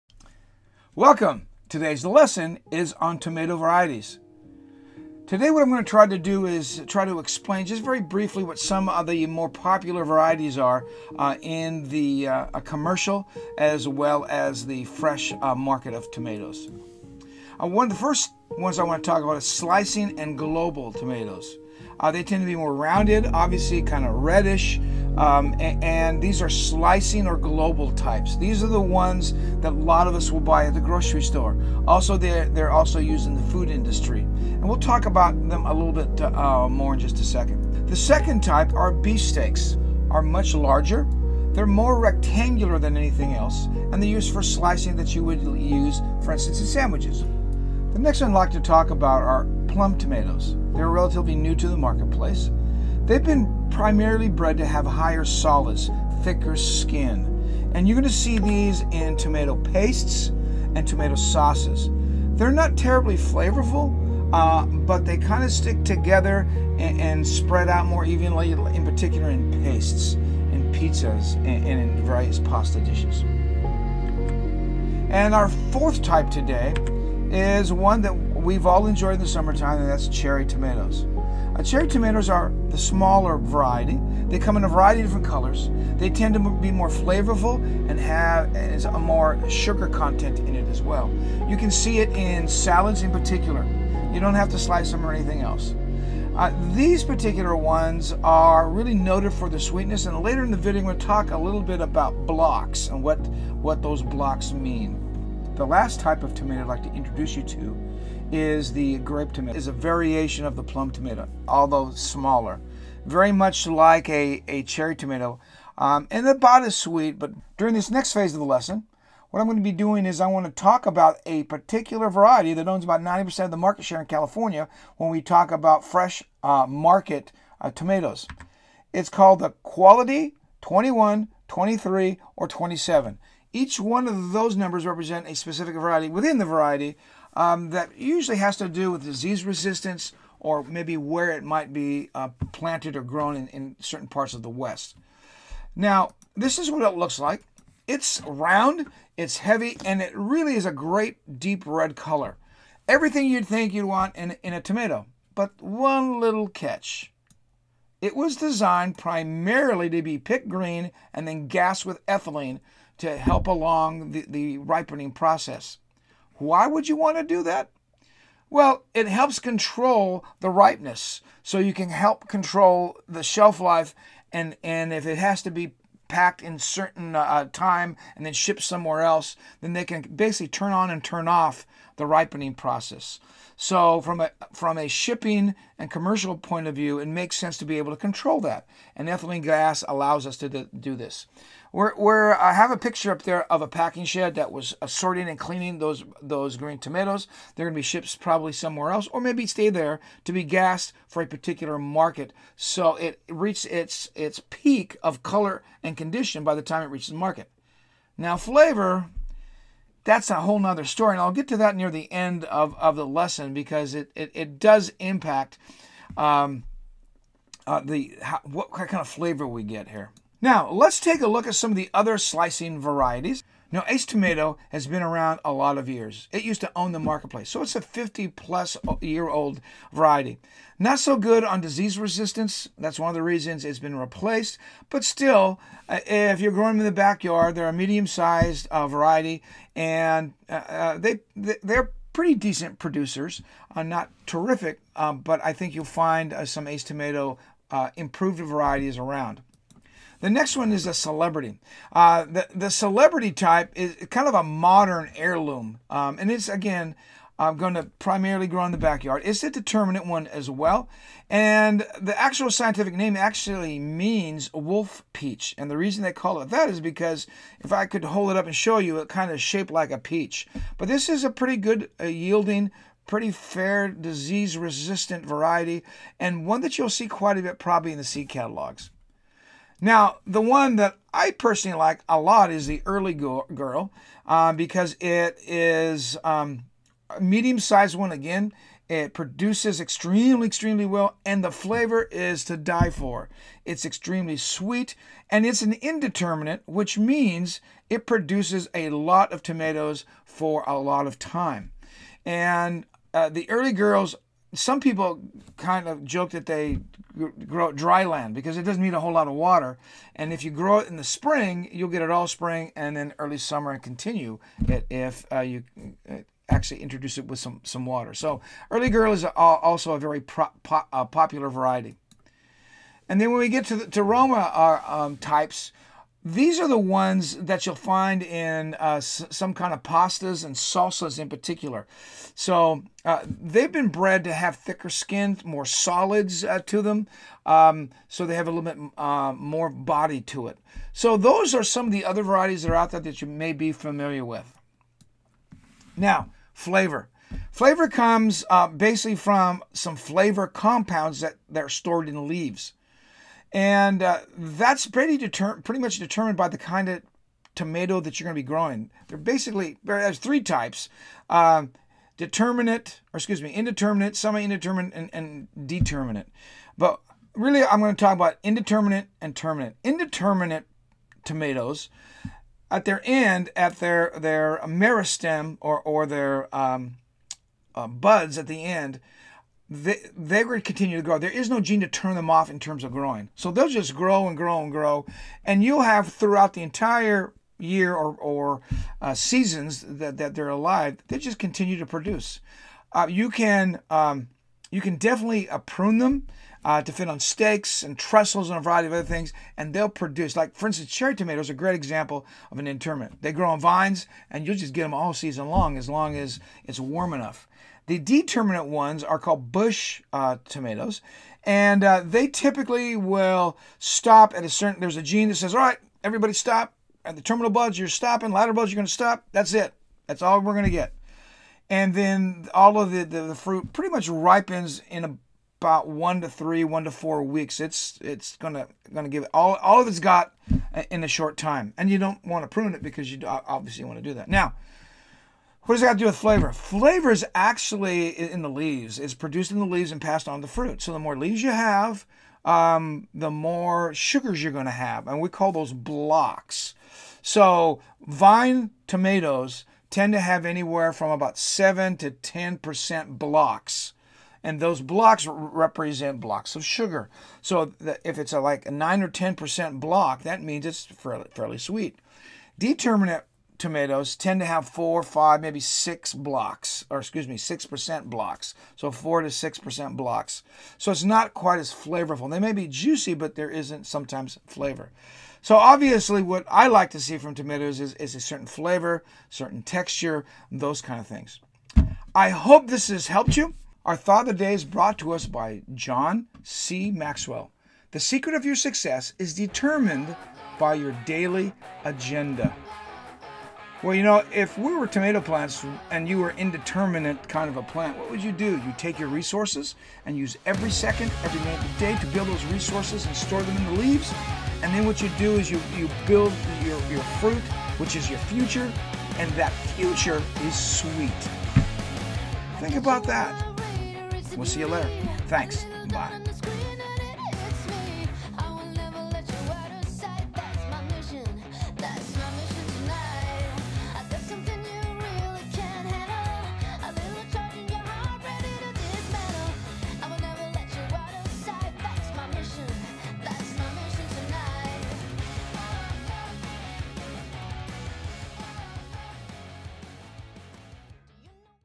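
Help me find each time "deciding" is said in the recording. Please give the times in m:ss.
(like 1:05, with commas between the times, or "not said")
not said.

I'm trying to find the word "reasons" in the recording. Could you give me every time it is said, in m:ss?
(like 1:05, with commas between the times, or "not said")
3:53, 4:25.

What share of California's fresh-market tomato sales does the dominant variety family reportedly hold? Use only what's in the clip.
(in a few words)
90%.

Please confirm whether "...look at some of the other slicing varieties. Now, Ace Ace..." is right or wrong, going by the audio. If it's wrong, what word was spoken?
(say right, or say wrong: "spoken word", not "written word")
wrong: "Tomato", not "Ace".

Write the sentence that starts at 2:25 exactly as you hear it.
Now, this is what it looks like.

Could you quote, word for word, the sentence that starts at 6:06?
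But really, I'm going to talk about indeterminate and terminate.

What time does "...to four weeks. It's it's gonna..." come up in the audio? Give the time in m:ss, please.
7:06.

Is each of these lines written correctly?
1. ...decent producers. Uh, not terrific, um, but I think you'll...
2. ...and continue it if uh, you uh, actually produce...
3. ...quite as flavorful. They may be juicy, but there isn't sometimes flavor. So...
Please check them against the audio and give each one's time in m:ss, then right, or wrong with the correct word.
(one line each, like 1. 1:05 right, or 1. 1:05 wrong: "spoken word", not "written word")
1. 4:02 right
2. 5:13 wrong: "introduce", not "produce"
3. 7:51 right.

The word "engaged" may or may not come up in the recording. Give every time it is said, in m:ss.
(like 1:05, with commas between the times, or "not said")
not said.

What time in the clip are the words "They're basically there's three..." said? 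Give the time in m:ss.
5:59.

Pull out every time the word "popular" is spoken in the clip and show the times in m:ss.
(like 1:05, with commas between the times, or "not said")
0:09, 5:21.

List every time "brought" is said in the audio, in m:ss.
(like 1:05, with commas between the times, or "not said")
8:04.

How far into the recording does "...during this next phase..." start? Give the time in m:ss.
1:57.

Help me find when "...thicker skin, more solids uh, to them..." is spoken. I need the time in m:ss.
5:34.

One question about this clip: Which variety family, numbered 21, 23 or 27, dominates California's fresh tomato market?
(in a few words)
Quality.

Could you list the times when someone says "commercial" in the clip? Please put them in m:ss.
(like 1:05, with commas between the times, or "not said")
0:12, 3:05.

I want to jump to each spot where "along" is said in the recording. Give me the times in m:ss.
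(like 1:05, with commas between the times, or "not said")
2:43.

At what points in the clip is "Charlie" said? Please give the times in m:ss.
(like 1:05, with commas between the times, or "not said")
not said.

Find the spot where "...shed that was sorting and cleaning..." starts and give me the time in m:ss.
3:14.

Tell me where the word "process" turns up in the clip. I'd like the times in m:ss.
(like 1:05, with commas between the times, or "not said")
2:45, 3:02.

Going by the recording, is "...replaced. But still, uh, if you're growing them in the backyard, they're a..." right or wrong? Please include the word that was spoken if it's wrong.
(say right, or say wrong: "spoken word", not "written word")
right.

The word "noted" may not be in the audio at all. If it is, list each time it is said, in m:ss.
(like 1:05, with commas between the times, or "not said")
1:38.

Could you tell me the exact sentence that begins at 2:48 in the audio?
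Well, it helps control the ripeness.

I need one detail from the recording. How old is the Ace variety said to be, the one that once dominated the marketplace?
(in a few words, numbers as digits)
50 plus years.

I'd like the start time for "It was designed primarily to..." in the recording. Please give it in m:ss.
2:38.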